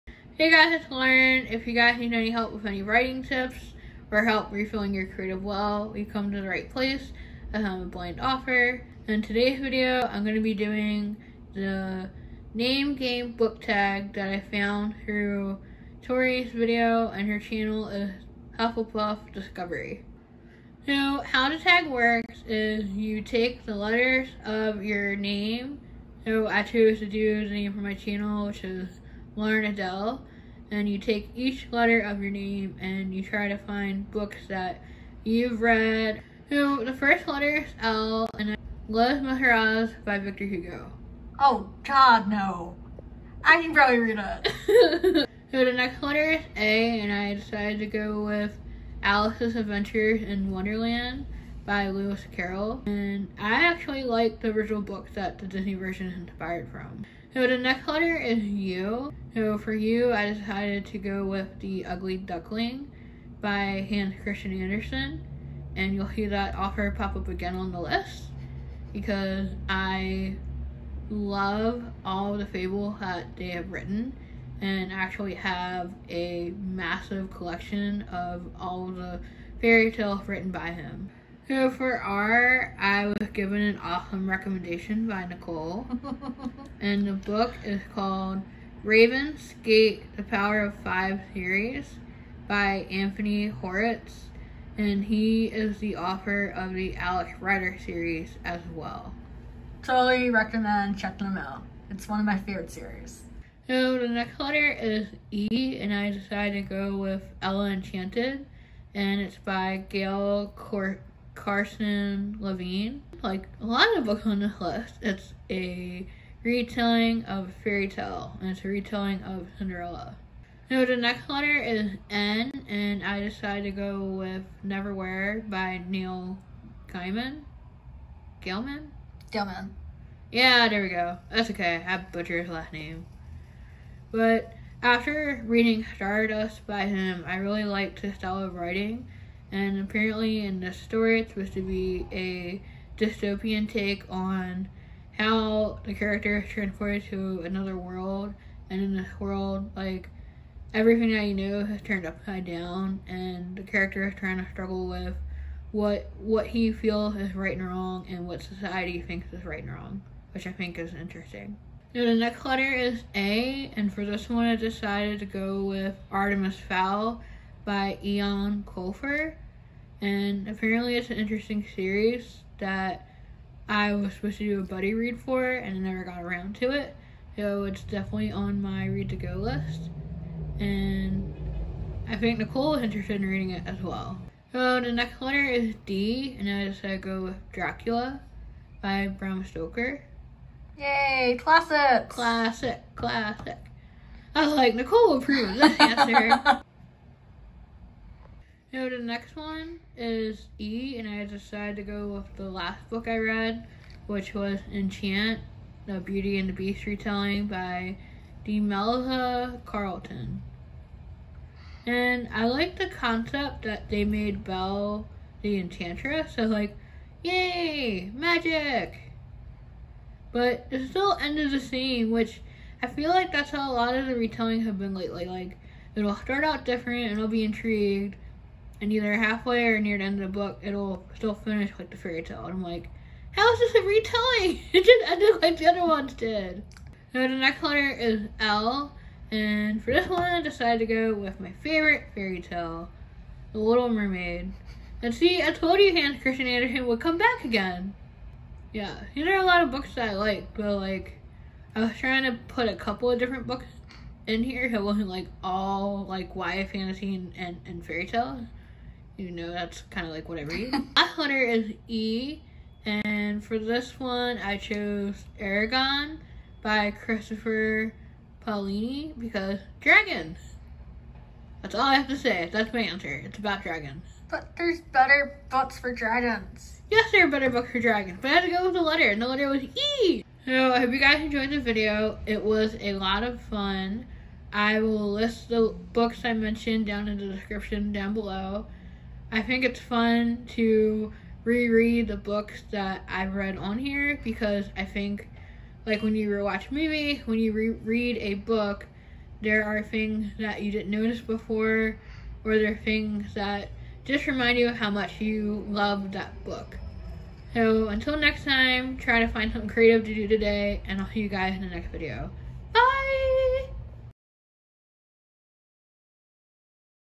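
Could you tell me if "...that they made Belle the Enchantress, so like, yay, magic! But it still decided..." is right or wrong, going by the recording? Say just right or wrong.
wrong.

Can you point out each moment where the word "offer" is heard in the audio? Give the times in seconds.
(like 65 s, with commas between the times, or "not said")
8 s, 66 s.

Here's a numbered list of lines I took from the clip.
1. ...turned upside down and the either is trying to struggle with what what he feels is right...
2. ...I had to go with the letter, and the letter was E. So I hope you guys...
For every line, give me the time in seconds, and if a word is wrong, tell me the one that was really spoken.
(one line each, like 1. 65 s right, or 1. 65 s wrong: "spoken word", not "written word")
1. 151 s wrong: "character", not "either"
2. 278 s right.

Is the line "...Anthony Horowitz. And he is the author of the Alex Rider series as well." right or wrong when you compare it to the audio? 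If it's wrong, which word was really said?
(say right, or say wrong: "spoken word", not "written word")
right.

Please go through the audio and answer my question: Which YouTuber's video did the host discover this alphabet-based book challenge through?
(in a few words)
Tori.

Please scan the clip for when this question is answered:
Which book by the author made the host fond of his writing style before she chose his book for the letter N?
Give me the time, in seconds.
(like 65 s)
135 s.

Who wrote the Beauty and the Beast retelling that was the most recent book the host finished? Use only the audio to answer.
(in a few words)
Demelza Carlton.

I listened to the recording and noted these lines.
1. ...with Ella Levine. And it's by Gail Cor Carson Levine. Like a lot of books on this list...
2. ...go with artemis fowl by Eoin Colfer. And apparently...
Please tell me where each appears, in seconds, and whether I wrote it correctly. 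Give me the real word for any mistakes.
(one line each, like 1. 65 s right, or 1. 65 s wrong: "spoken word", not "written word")
1. 106 s wrong: "Enchanted", not "Levine"
2. 165 s right.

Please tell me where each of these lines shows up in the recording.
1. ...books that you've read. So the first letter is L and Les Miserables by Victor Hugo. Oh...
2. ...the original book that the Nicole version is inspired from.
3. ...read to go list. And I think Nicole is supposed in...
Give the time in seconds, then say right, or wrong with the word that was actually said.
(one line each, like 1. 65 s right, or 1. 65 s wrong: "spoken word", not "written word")
1. 34 s right
2. 54 s wrong: "Disney", not "Nicole"
3. 178 s wrong: "interested", not "supposed".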